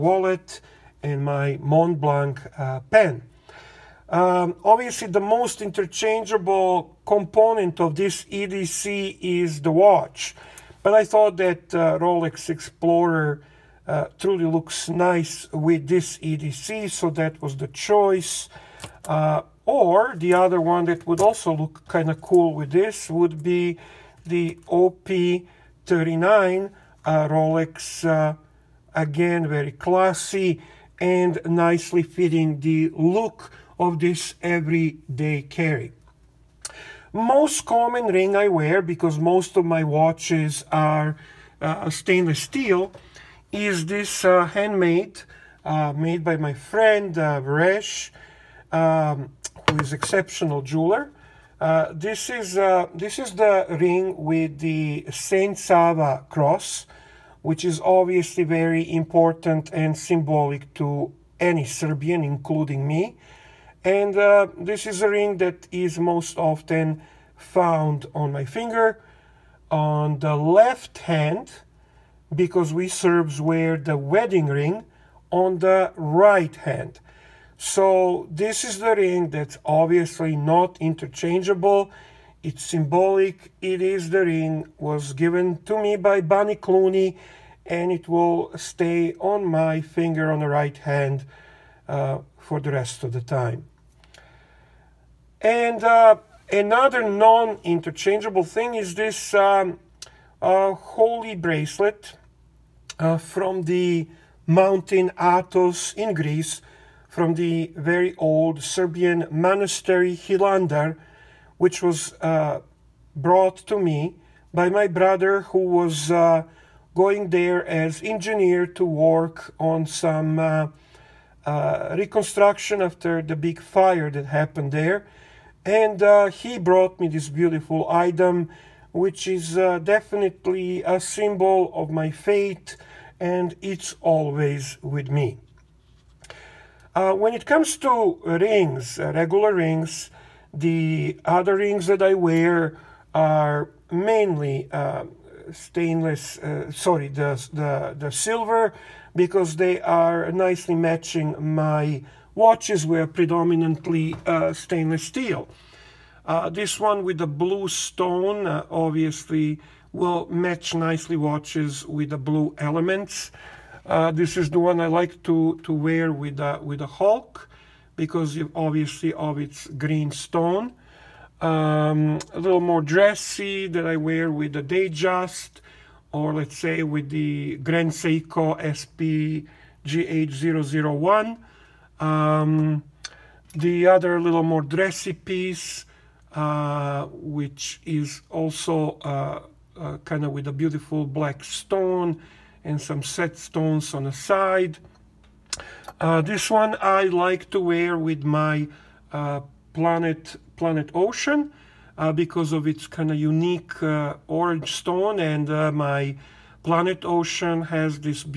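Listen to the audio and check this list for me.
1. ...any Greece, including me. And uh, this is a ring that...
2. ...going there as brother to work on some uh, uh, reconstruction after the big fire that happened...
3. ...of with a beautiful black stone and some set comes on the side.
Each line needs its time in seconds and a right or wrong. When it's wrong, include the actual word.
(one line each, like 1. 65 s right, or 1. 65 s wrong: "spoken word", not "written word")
1. 61 s wrong: "Serbian", not "Greece"
2. 116 s wrong: "engineer", not "brother"
3. 190 s wrong: "stones", not "comes".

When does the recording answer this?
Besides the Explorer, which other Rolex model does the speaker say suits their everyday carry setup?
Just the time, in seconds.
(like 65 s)
24 s.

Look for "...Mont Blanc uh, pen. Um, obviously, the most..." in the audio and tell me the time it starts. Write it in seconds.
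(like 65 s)
1 s.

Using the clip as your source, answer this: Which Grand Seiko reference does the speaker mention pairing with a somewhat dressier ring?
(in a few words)
SPGH001.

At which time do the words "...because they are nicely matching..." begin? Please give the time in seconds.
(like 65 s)
149 s.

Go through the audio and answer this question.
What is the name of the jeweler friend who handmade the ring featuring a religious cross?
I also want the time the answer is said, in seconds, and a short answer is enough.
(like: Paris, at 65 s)
Resh, at 47 s.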